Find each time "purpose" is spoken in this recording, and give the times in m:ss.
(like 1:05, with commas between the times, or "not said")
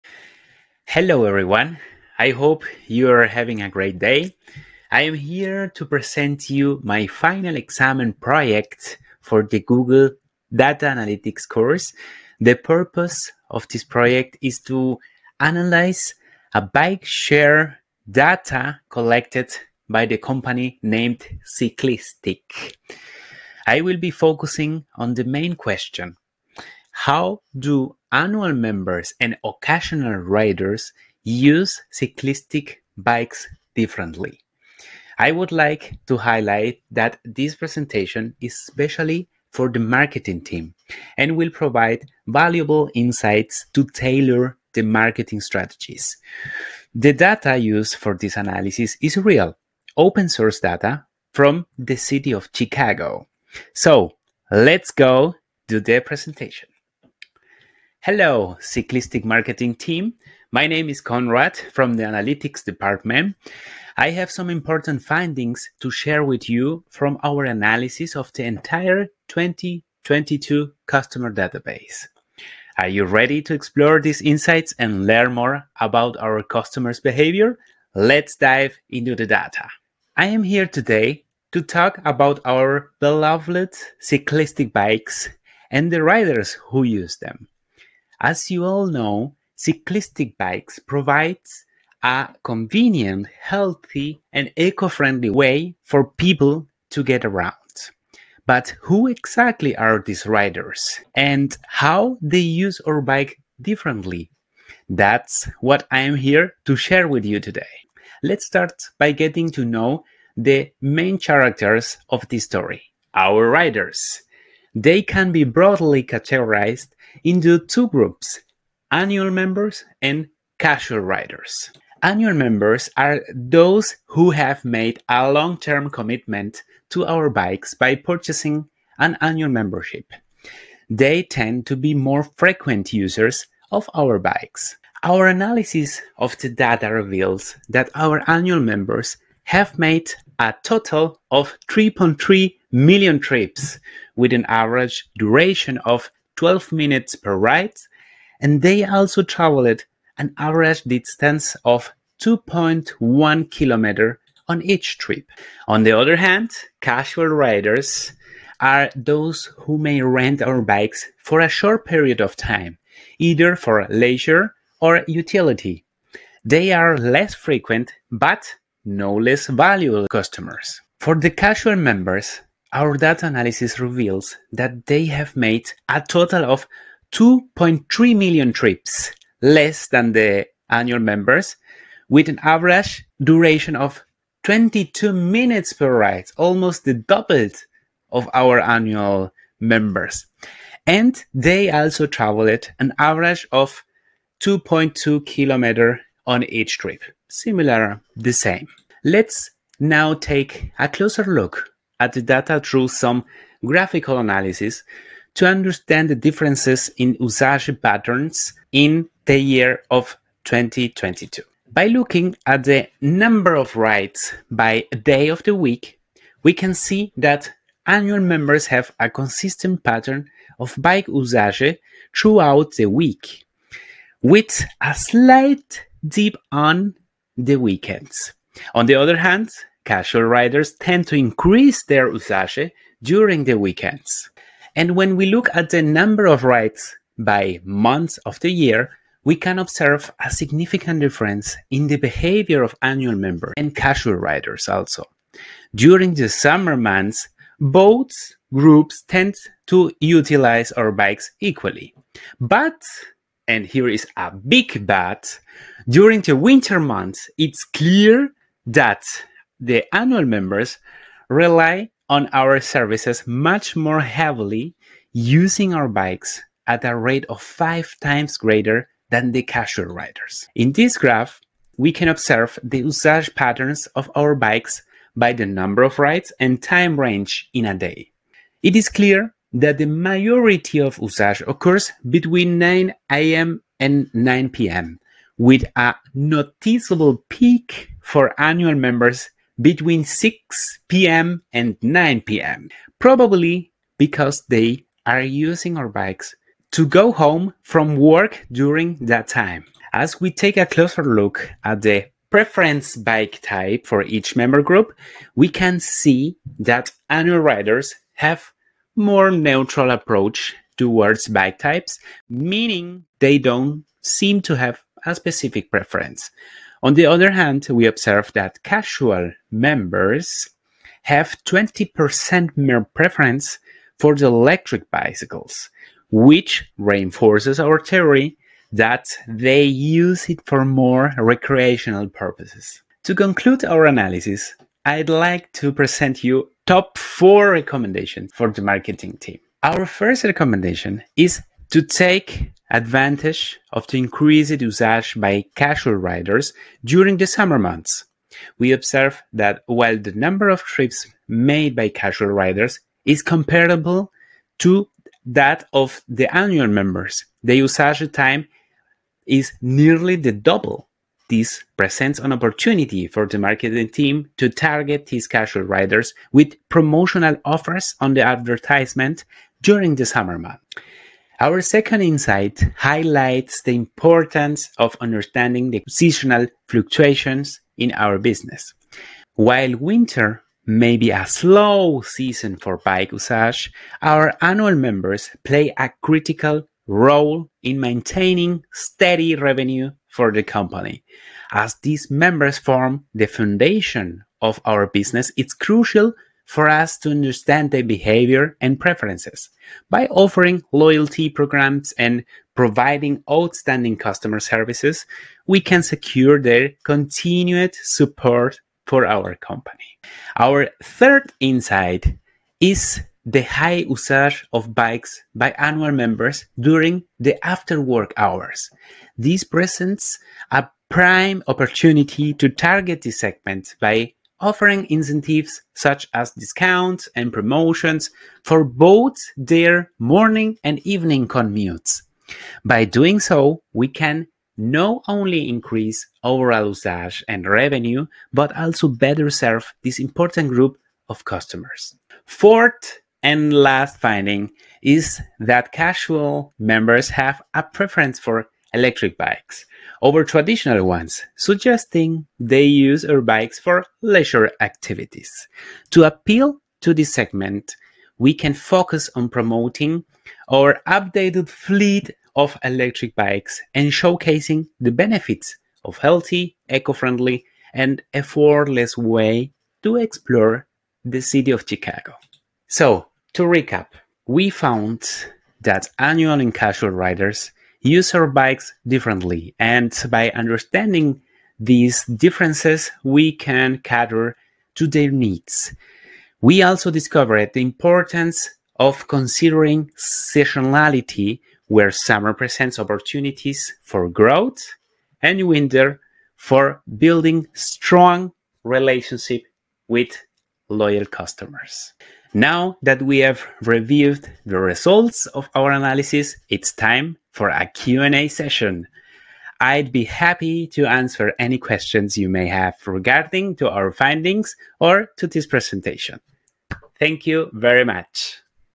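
0:12, 5:32.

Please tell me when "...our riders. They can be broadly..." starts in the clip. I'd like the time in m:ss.
1:53.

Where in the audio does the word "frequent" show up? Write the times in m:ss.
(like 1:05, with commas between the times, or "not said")
2:12, 2:47.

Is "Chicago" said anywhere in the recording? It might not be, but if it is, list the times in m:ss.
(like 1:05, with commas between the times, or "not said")
0:52, 7:51.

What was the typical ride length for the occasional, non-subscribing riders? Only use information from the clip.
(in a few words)
22 minutes.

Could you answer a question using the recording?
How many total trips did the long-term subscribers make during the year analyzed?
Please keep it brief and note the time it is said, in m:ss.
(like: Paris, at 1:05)
3.3 million, at 2:21.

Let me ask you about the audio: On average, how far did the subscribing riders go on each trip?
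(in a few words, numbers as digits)
2.1 kilometers.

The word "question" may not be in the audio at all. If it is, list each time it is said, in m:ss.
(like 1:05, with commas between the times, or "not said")
0:25, 8:31.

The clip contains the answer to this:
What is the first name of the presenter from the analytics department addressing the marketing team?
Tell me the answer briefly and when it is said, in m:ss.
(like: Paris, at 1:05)
Conrad, at 1:01.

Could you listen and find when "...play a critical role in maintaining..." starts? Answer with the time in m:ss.
6:25.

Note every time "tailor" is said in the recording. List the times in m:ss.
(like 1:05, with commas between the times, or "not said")
0:43.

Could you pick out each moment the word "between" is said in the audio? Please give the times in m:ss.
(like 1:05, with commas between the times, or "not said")
4:42, 4:49.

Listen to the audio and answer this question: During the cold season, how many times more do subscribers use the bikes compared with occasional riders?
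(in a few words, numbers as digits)
5 times.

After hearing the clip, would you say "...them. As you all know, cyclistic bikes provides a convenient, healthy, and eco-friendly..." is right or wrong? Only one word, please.
right.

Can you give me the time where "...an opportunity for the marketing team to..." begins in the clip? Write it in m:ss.
6:02.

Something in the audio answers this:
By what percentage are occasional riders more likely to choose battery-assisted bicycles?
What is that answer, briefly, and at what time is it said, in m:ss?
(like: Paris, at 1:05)
20%, at 5:21.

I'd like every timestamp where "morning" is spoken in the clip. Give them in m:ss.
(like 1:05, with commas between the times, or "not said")
7:09.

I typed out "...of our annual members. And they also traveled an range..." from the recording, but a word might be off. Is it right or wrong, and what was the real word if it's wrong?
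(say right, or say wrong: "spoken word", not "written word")
wrong: "average", not "range".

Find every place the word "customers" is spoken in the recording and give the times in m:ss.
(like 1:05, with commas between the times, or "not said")
1:10, 1:16, 2:50, 6:43, 7:21, 8:21.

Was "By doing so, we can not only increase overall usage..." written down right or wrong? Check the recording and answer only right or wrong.
right.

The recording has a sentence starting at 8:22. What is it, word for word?
Now that we have reviewed the results of our analysis, it's time for a Q&A session.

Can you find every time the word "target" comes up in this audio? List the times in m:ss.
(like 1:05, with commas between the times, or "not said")
6:04, 7:02.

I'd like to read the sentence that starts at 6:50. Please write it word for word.
Our third insight is the high usage of bikes by annual members during the after work hours.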